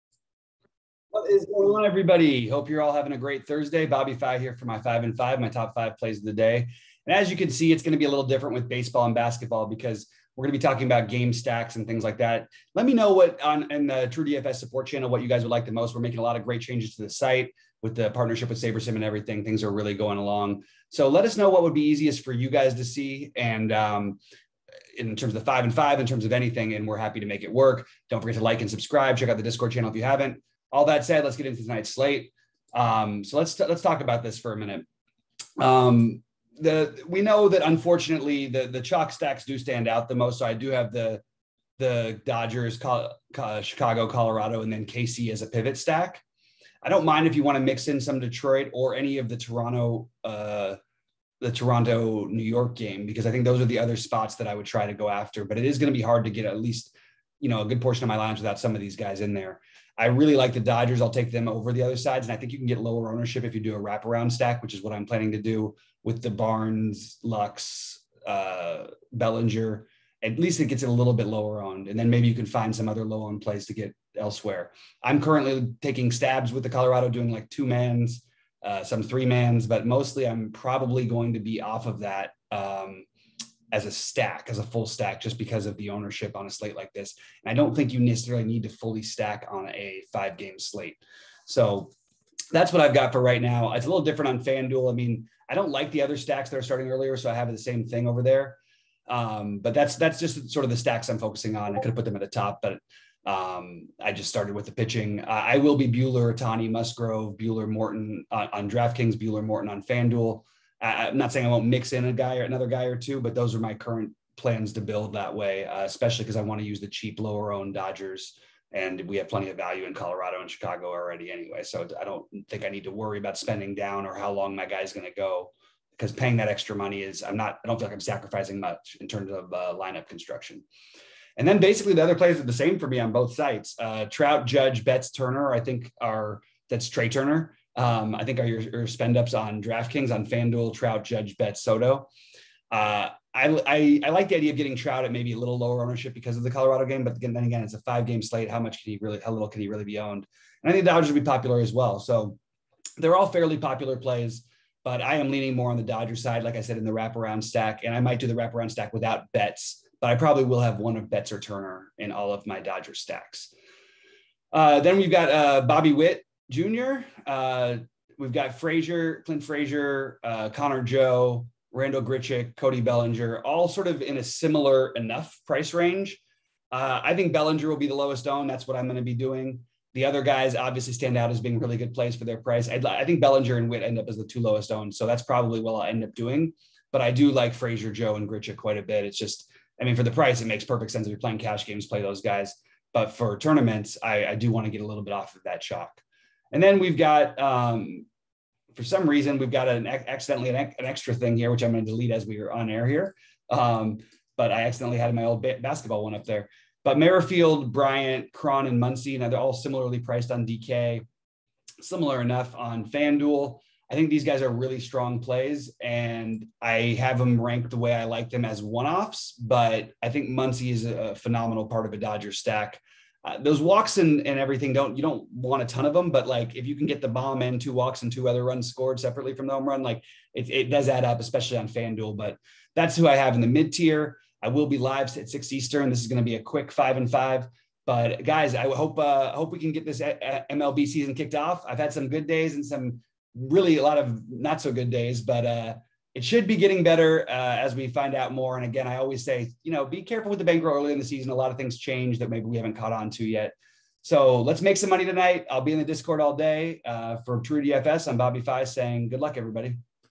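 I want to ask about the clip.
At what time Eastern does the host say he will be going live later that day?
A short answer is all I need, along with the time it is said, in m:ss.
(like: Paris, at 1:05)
6 Eastern, at 3:55.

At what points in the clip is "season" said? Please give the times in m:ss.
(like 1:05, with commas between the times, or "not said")
4:00, 4:11.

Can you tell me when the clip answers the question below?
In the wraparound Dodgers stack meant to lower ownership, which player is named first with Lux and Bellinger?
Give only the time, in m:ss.
1:06.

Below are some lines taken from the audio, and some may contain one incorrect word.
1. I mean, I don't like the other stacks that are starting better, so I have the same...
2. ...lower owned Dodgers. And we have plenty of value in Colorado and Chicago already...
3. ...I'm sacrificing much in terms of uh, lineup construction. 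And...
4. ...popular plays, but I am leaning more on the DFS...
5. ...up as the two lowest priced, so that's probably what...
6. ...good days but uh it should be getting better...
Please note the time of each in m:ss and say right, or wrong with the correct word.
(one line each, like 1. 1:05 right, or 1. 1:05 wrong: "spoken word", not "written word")
1. 1:34 wrong: "earlier", not "better"
2. 1:57 right
3. 2:07 right
4. 2:33 wrong: "Dodger", not "DFS"
5. 3:03 wrong: "owned", not "priced"
6. 4:04 right.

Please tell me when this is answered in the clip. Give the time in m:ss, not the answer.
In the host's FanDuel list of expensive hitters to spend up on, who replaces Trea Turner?
2:21.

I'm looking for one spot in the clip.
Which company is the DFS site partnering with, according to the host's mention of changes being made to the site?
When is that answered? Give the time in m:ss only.
0:18.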